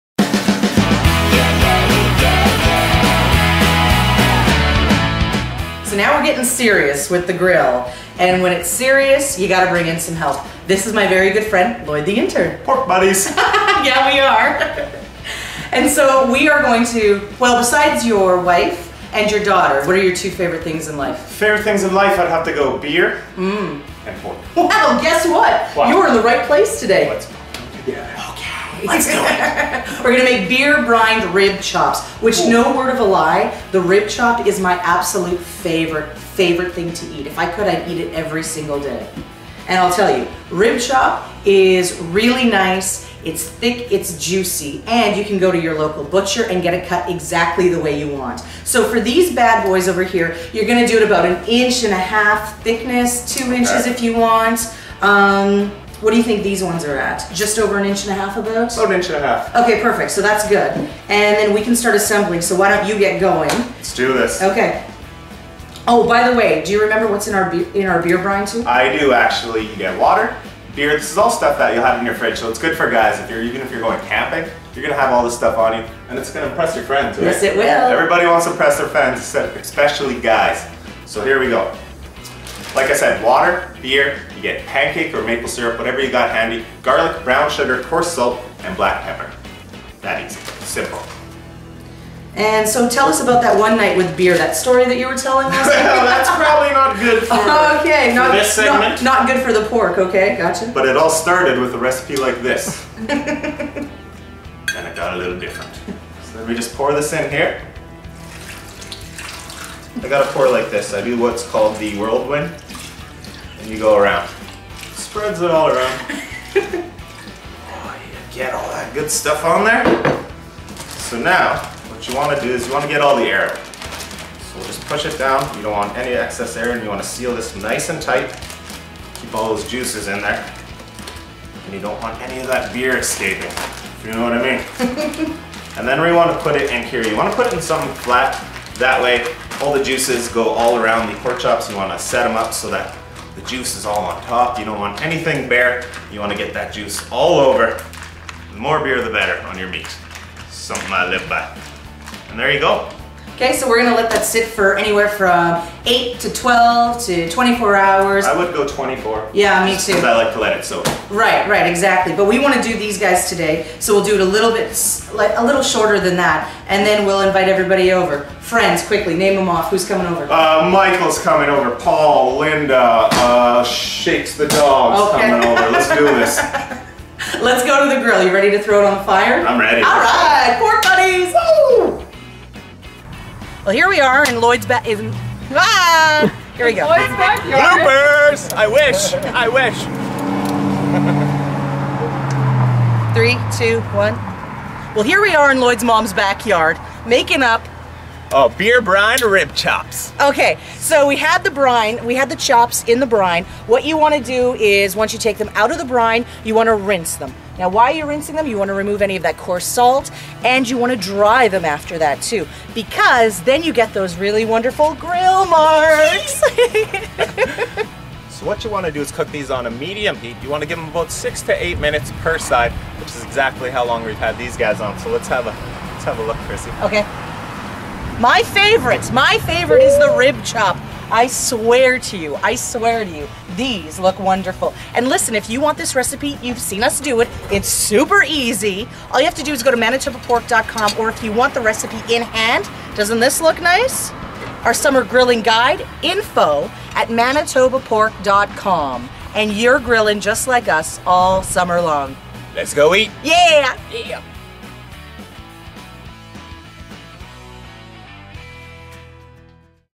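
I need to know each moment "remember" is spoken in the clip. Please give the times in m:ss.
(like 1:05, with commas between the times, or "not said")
1:06.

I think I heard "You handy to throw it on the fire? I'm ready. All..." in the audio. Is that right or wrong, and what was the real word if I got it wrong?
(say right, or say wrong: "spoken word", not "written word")
wrong: "ready", not "handy".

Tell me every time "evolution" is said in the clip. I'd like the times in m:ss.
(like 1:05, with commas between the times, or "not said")
not said.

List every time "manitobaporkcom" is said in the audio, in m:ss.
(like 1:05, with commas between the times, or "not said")
3:59, 4:07.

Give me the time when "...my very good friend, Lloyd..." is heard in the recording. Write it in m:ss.
0:10.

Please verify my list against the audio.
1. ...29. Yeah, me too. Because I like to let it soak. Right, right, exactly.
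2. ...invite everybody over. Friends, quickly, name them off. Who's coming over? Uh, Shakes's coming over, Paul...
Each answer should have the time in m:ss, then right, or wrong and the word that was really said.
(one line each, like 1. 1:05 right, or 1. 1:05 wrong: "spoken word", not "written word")
1. 2:38 wrong: "24", not "29"
2. 2:47 wrong: "Michael", not "Shakes".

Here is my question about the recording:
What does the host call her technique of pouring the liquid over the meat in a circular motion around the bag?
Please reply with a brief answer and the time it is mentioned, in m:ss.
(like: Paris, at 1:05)
the whirlwind, at 1:51.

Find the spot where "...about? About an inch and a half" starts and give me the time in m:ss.
0:58.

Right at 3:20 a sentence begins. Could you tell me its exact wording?
Okay, so we had the brine, we had the chops in the brine.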